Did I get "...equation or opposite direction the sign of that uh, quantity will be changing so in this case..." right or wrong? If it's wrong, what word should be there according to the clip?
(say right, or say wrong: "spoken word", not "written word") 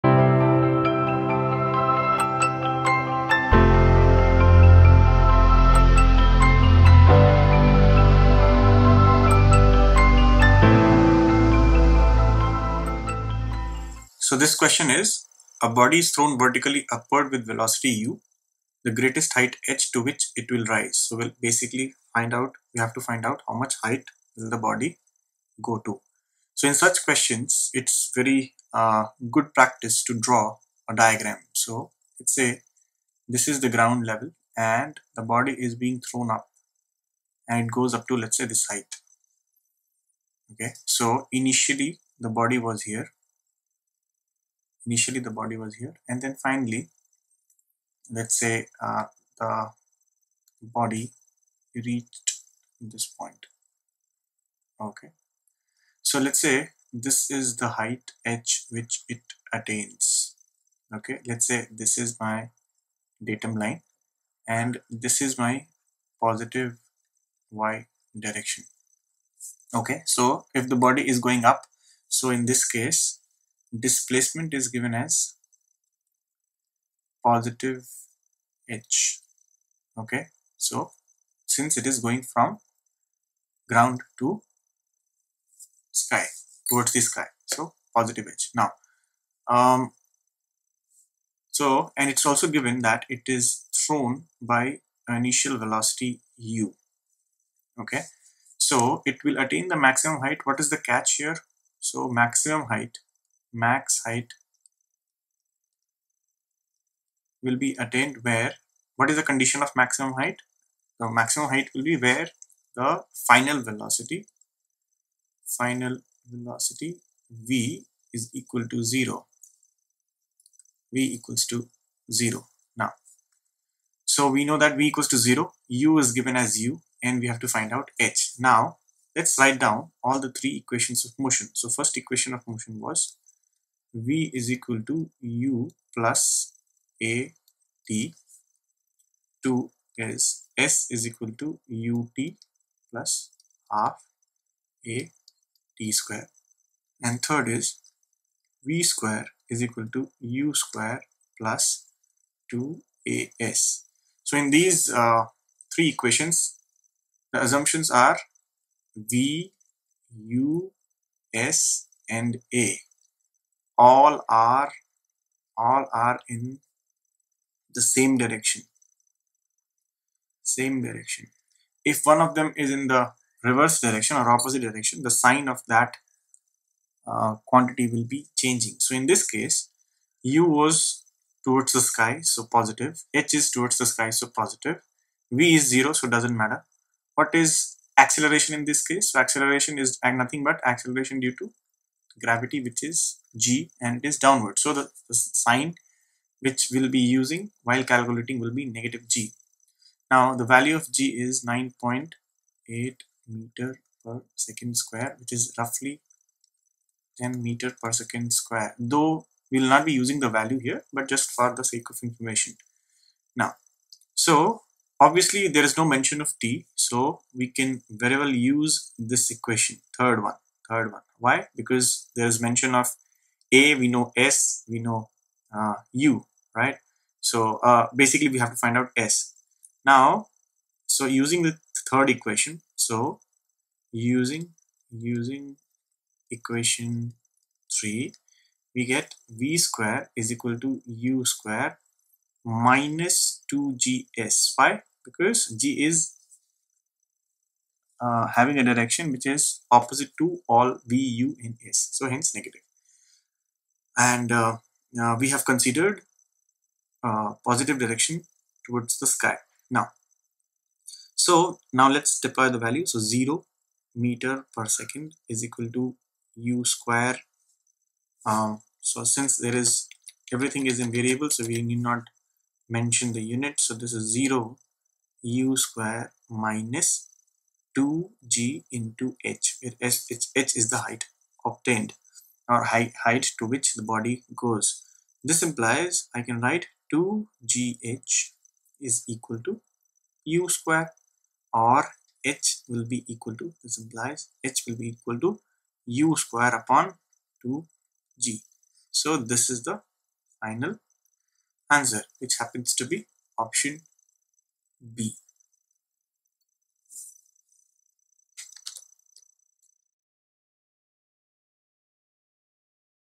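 wrong: "direction", not "equation".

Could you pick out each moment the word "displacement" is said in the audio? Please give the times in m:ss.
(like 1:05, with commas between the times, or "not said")
1:13.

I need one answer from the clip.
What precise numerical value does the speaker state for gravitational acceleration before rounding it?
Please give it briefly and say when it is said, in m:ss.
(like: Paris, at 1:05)
9.8 m/s², at 3:21.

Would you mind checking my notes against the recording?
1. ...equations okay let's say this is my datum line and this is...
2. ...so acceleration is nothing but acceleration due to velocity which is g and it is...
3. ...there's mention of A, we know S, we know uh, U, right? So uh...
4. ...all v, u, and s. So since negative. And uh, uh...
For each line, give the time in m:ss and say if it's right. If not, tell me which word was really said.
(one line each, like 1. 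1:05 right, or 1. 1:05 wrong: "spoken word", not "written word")
1. 0:59 wrong: "attains", not "equations"
2. 3:09 wrong: "gravity", not "velocity"
3. 3:42 right
4. 4:10 wrong: "hence", not "since".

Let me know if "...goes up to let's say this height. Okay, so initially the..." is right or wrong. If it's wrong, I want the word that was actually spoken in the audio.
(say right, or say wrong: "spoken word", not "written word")
right.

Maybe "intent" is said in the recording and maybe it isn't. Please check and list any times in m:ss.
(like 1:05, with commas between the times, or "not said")
not said.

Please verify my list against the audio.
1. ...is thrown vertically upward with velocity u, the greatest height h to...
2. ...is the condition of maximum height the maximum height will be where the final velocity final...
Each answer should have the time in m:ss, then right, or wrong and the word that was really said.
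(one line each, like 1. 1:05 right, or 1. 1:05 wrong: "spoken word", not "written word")
1. 0:15 right
2. 1:49 right.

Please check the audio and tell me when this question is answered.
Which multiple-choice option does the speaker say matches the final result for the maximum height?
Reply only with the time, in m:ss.
5:03.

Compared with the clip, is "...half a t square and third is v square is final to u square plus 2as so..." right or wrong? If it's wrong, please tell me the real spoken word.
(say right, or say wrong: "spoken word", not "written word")
wrong: "equal", not "final".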